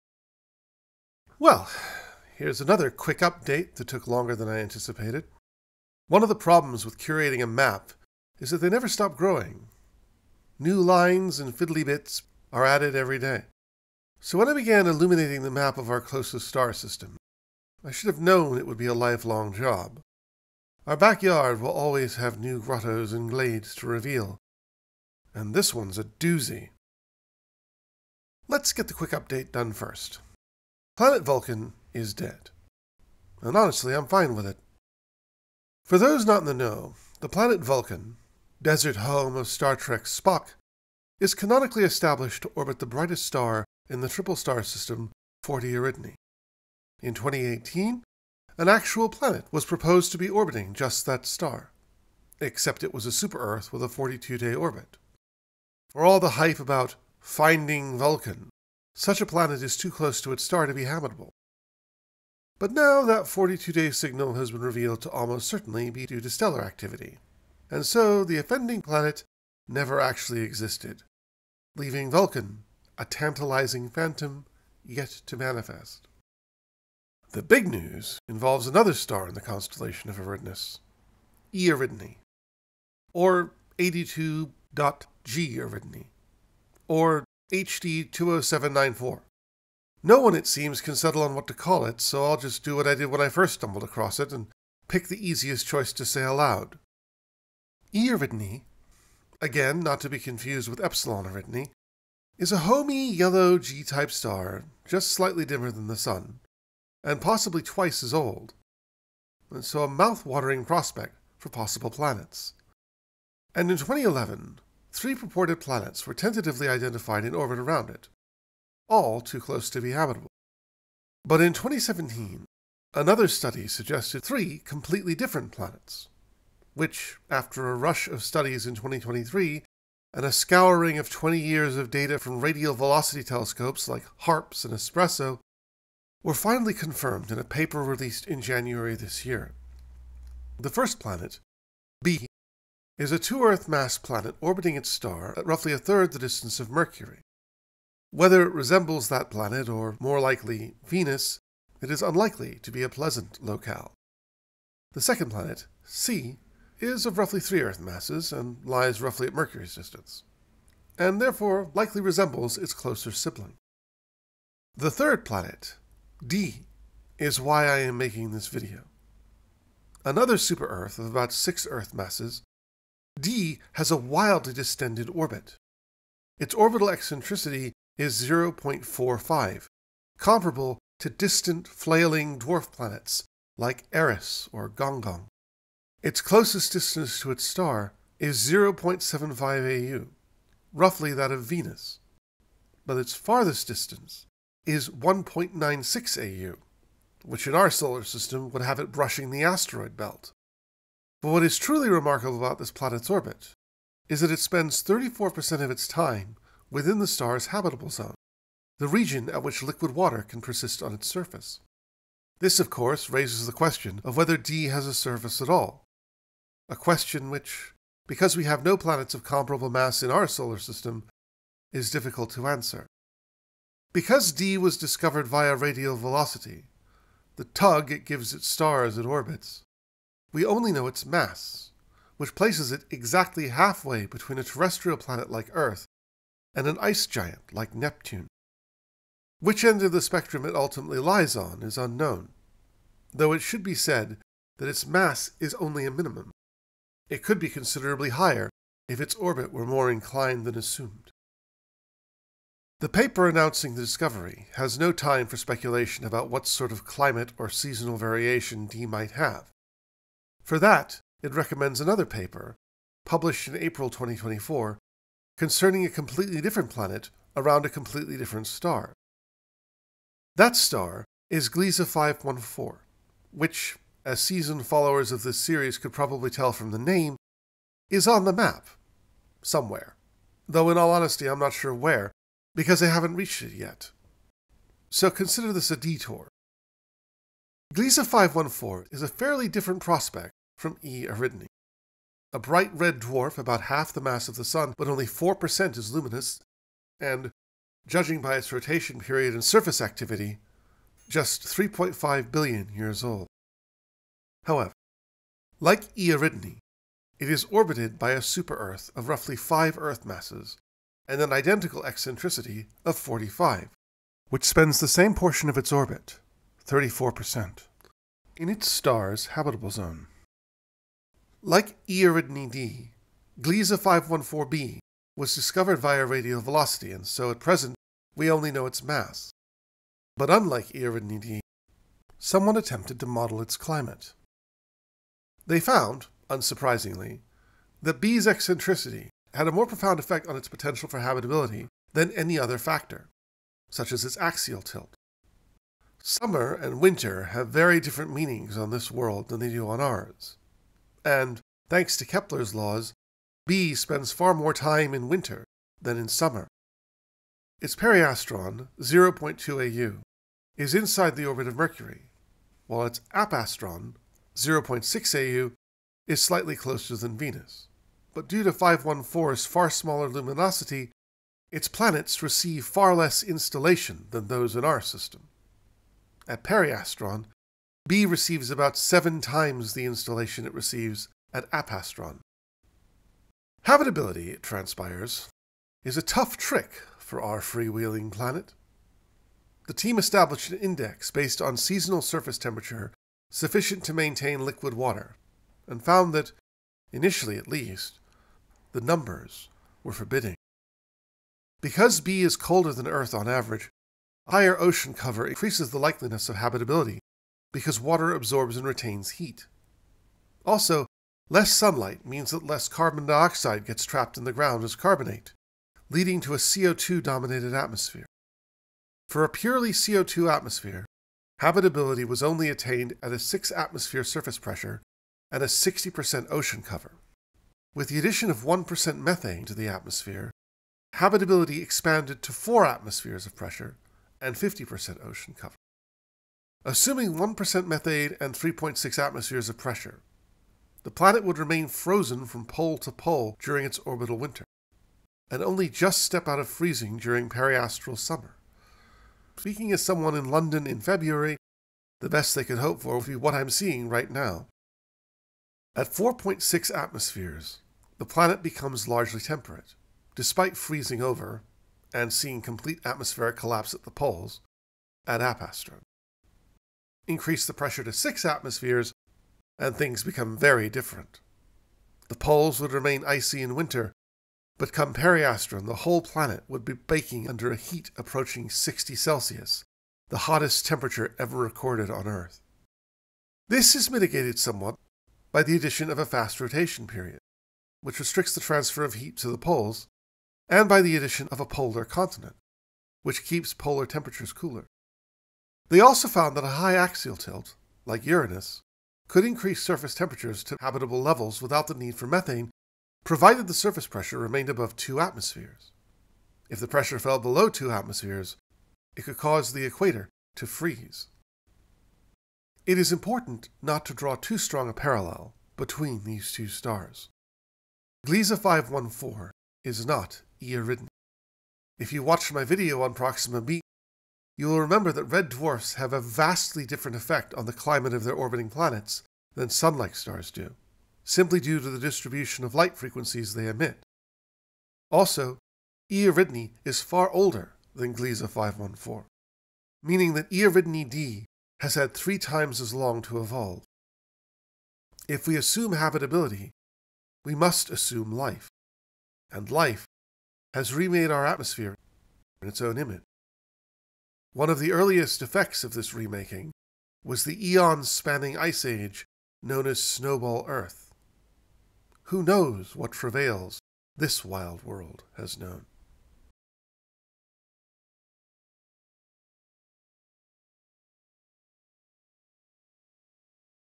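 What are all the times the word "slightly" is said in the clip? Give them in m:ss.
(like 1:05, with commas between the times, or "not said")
1:45, 6:06.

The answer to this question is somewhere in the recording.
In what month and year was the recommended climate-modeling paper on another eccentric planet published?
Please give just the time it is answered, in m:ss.
4:23.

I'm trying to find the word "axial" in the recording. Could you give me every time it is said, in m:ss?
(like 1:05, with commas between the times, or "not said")
5:44, 8:16.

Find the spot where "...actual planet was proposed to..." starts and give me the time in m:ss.
0:48.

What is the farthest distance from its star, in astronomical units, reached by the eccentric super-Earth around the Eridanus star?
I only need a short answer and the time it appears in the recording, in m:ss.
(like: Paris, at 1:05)
1.96 AU, at 3:14.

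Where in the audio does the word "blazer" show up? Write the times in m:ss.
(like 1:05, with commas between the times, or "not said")
not said.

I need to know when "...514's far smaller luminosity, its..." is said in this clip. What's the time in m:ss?
6:08.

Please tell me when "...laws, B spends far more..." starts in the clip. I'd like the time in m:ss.
5:52.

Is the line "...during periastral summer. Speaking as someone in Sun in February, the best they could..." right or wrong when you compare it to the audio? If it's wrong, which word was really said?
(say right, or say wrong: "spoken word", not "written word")
wrong: "London", not "Sun".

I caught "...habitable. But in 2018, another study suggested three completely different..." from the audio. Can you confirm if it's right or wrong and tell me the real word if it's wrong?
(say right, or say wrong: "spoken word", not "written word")
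wrong: "2017", not "2018".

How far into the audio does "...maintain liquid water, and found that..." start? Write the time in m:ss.
6:33.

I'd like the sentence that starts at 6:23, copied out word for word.
Habitability, it transpires, is a tough trick for our freewheeling planet.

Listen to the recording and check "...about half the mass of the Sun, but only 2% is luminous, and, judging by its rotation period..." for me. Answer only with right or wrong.
wrong.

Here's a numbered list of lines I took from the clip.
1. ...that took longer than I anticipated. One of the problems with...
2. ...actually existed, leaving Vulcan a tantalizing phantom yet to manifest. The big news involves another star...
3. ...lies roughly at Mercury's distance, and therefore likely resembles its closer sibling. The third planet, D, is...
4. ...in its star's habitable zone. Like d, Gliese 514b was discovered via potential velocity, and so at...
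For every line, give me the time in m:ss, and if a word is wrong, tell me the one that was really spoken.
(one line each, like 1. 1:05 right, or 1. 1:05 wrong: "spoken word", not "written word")
1. 0:03 right
2. 1:09 right
3. 2:38 right
4. 5:18 wrong: "radial", not "potential".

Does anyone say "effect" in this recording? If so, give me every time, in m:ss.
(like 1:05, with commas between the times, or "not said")
5:39, 8:46, 9:15.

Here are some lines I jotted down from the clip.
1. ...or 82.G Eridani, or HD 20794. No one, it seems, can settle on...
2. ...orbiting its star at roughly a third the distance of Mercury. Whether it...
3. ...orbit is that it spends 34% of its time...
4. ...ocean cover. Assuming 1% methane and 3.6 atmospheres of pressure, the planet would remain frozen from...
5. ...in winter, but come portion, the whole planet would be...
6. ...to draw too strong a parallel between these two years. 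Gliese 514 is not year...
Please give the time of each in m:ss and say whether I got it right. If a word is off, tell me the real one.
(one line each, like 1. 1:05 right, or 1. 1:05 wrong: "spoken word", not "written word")
1. 1:23 right
2. 2:24 right
3. 3:23 right
4. 7:15 right
5. 7:53 wrong: "periastron", not "portion"
6. 8:33 wrong: "stars", not "years".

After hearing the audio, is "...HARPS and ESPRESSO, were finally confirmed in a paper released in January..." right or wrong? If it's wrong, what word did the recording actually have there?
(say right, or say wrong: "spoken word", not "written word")
right.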